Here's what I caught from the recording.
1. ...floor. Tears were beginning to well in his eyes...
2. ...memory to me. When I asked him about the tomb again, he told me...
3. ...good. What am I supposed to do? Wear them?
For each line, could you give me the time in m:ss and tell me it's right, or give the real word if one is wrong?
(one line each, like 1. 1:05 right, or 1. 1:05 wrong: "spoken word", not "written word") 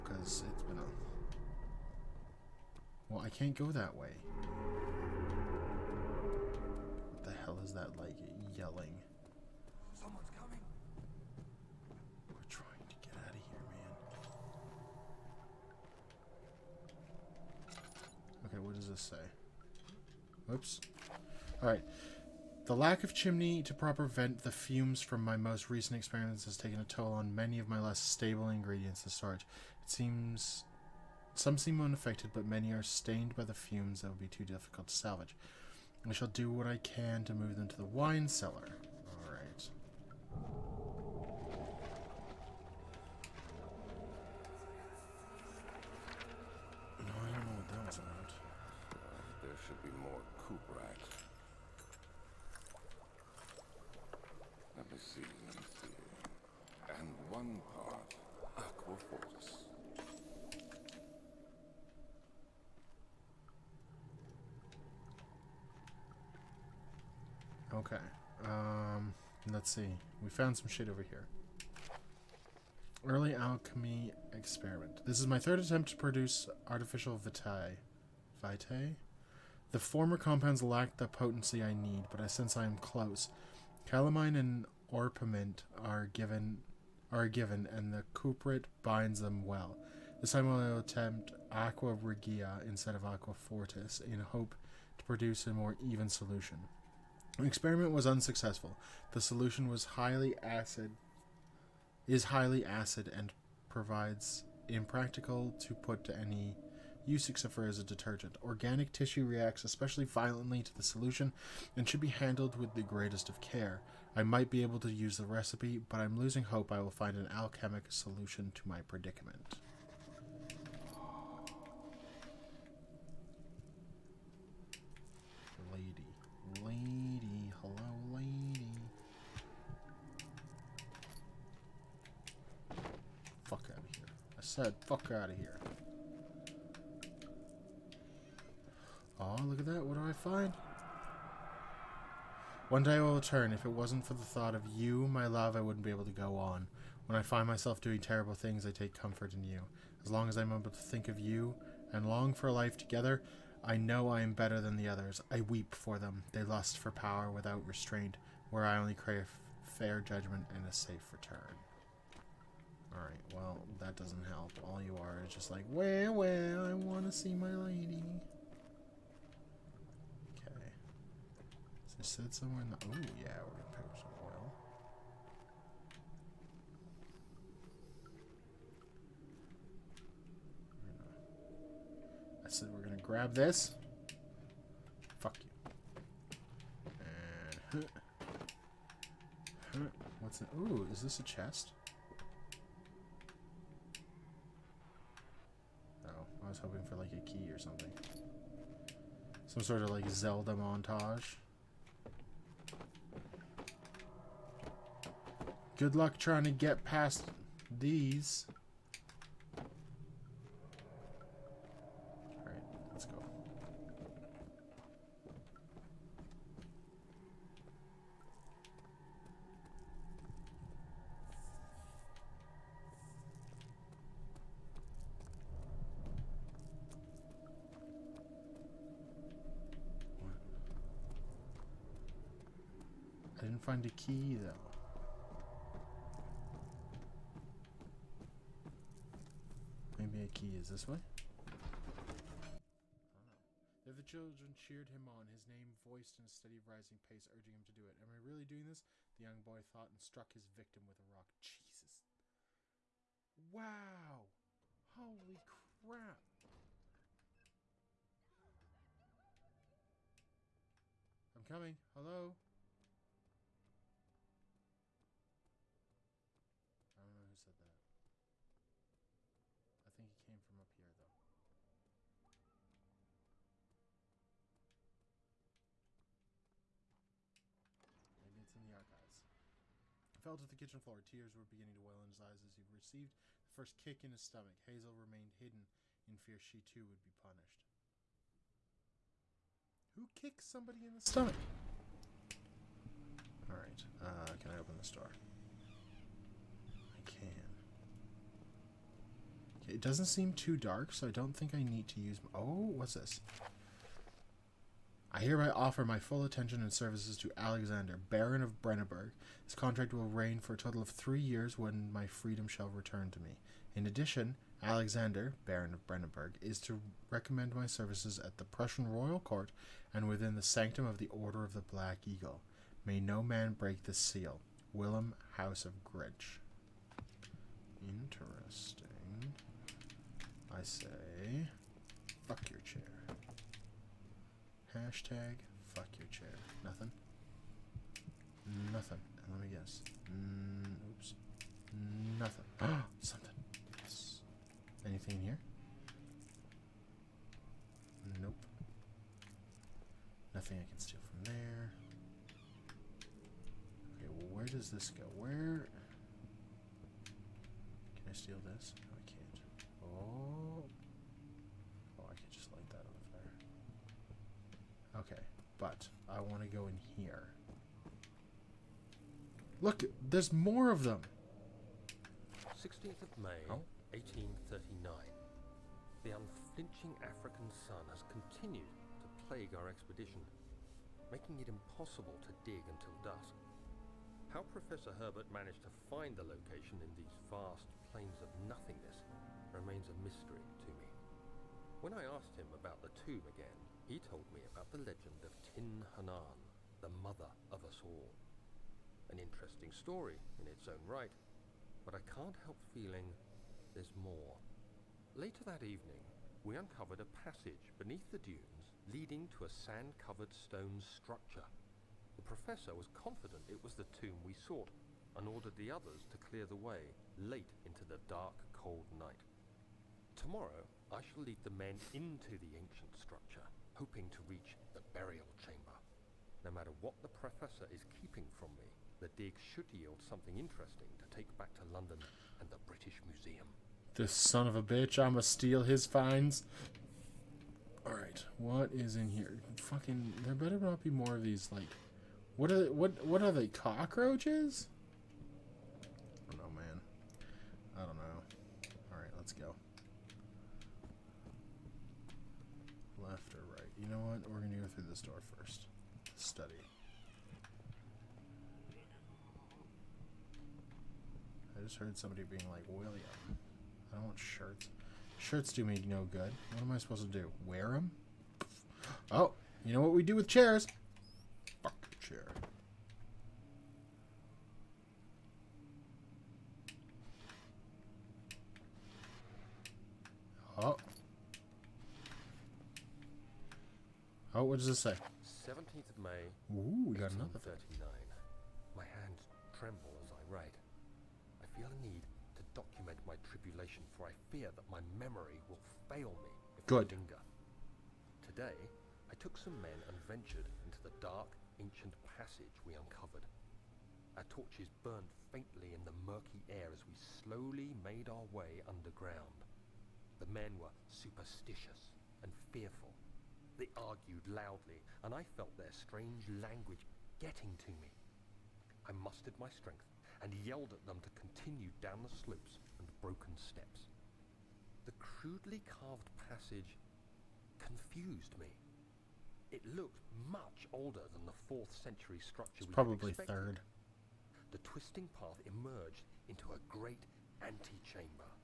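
1. 4:40 right
2. 6:30 wrong: "mystery", not "memory"
3. 7:46 right.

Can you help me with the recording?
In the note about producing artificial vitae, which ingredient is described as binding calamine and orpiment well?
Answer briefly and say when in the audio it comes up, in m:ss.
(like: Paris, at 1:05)
cuprite, at 1:28.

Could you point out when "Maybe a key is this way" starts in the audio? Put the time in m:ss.
3:59.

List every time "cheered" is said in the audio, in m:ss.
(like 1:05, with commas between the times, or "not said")
4:04.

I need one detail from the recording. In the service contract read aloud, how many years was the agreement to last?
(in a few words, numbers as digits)
3.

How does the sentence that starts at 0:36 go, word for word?
I shall do what I can to move them to the wine cellar.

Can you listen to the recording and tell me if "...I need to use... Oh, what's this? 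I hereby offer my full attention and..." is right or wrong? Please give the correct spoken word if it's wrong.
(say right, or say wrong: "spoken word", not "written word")
right.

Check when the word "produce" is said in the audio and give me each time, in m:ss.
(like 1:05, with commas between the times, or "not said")
1:15, 1:35.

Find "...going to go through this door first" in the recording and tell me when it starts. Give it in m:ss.
7:34.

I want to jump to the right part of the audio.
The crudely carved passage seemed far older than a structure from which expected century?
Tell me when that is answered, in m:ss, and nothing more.
8:51.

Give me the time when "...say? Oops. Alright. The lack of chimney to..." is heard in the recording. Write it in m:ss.
0:19.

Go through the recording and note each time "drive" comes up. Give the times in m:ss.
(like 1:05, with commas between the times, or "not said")
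not said.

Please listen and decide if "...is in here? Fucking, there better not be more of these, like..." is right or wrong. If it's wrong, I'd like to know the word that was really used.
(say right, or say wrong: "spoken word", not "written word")
right.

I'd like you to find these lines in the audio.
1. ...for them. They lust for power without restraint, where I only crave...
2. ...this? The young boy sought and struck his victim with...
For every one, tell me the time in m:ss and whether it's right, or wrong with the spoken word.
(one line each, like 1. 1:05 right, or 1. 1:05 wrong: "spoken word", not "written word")
1. 2:35 right
2. 4:08 wrong: "thought", not "sought".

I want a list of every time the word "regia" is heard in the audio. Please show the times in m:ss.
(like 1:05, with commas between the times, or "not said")
1:31.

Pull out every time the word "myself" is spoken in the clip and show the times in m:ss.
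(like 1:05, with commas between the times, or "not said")
2:27.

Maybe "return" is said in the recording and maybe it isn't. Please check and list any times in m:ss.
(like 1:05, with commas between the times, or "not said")
2:23, 2:41, 5:12.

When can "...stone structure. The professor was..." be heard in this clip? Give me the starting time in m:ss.
6:50.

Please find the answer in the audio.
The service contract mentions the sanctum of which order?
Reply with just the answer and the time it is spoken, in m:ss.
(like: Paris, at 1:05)
Order of the Black Eagle, at 5:21.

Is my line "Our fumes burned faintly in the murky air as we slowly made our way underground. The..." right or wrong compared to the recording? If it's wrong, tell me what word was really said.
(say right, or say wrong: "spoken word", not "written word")
wrong: "torches", not "fumes".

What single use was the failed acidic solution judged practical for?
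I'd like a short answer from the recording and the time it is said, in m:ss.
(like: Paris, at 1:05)
detergent, at 1:47.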